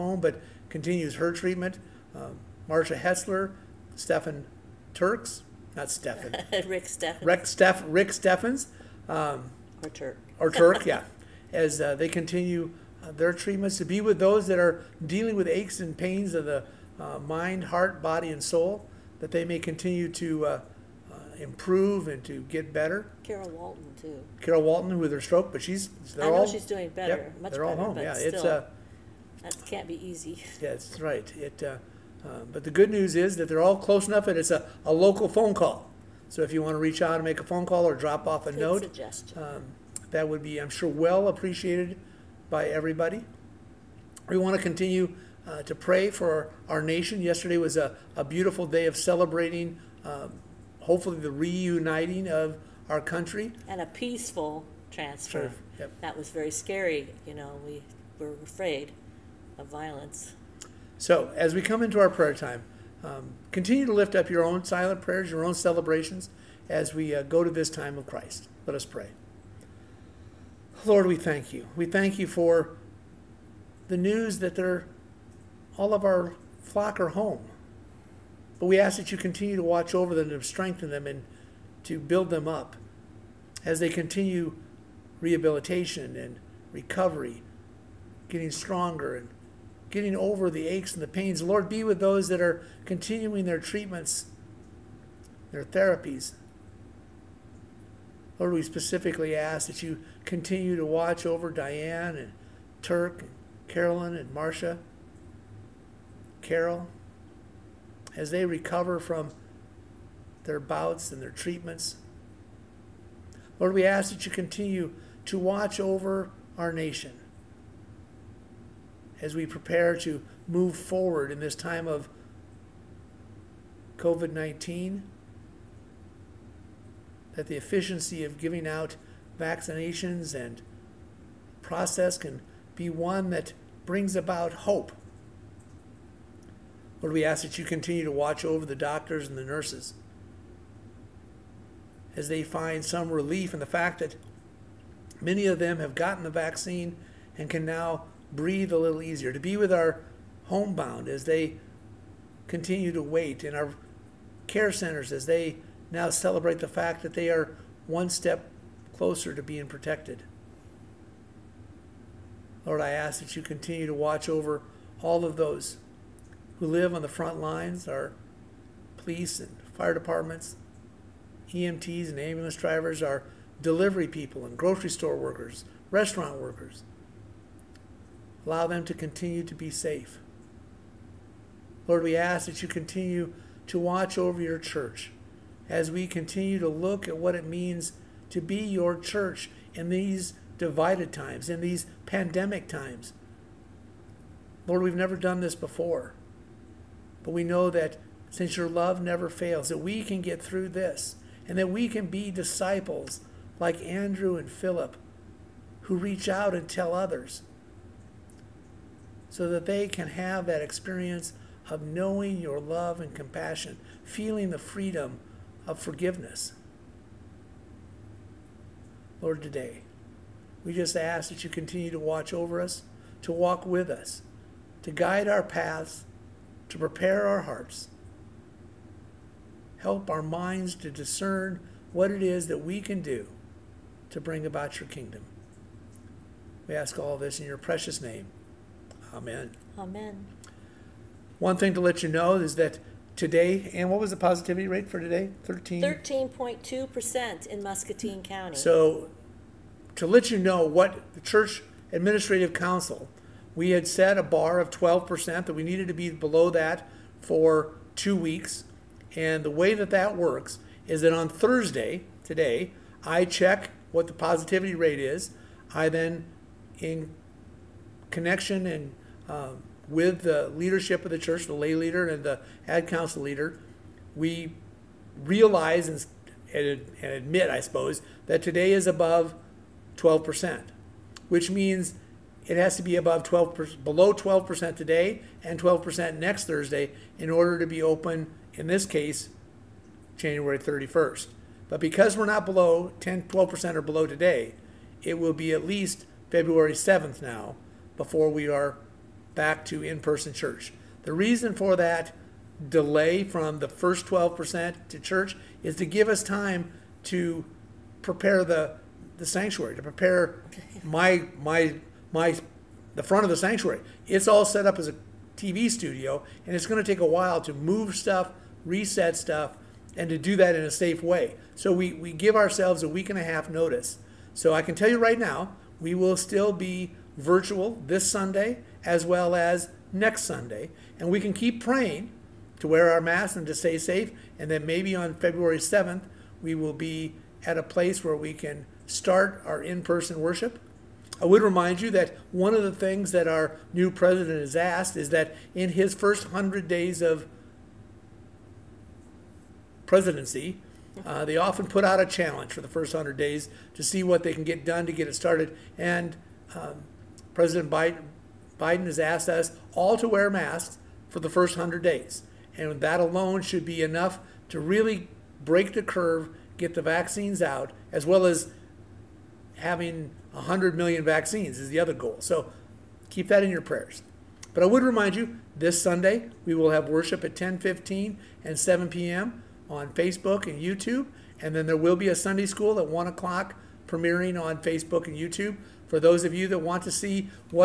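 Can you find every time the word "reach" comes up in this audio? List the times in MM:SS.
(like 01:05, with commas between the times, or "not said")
00:36, 03:25.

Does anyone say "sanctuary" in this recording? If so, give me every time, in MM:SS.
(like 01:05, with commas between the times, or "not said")
05:09, 05:13.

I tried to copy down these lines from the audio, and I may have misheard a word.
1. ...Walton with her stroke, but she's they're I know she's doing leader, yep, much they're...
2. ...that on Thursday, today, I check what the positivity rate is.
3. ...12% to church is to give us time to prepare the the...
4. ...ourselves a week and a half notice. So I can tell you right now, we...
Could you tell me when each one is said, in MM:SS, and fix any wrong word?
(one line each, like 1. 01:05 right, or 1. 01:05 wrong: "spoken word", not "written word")
1. 00:24 wrong: "better", not "leader"
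2. 04:21 right
3. 05:04 right
4. 05:22 right.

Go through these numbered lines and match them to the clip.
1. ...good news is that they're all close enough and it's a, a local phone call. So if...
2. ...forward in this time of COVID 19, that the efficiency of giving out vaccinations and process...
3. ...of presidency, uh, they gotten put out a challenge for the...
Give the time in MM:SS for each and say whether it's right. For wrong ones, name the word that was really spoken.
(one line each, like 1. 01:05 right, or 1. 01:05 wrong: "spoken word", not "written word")
1. 00:32 right
2. 02:00 right
3. 05:46 wrong: "often", not "gotten".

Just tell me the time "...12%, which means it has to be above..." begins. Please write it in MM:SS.
04:39.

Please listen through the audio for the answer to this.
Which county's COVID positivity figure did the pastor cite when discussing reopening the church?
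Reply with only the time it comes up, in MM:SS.
04:07.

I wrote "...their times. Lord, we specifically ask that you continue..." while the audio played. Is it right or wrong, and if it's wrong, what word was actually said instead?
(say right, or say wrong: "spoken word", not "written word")
wrong: "therapies", not "times".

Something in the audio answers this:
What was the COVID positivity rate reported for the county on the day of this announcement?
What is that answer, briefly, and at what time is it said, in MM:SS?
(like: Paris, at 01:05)
13.2%, at 04:05.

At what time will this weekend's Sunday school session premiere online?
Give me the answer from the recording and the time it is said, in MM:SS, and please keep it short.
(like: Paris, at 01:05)
1 o'clock, at 06:22.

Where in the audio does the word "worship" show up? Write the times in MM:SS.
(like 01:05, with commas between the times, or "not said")
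05:40, 06:16.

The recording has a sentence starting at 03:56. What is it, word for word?
We ask all this in your precious name.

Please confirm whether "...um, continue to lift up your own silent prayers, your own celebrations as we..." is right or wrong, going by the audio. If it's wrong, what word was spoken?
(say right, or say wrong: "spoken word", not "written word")
right.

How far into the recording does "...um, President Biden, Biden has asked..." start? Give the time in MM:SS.
05:56.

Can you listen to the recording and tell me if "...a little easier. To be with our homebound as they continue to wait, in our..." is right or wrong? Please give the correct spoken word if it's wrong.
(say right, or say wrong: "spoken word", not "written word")
right.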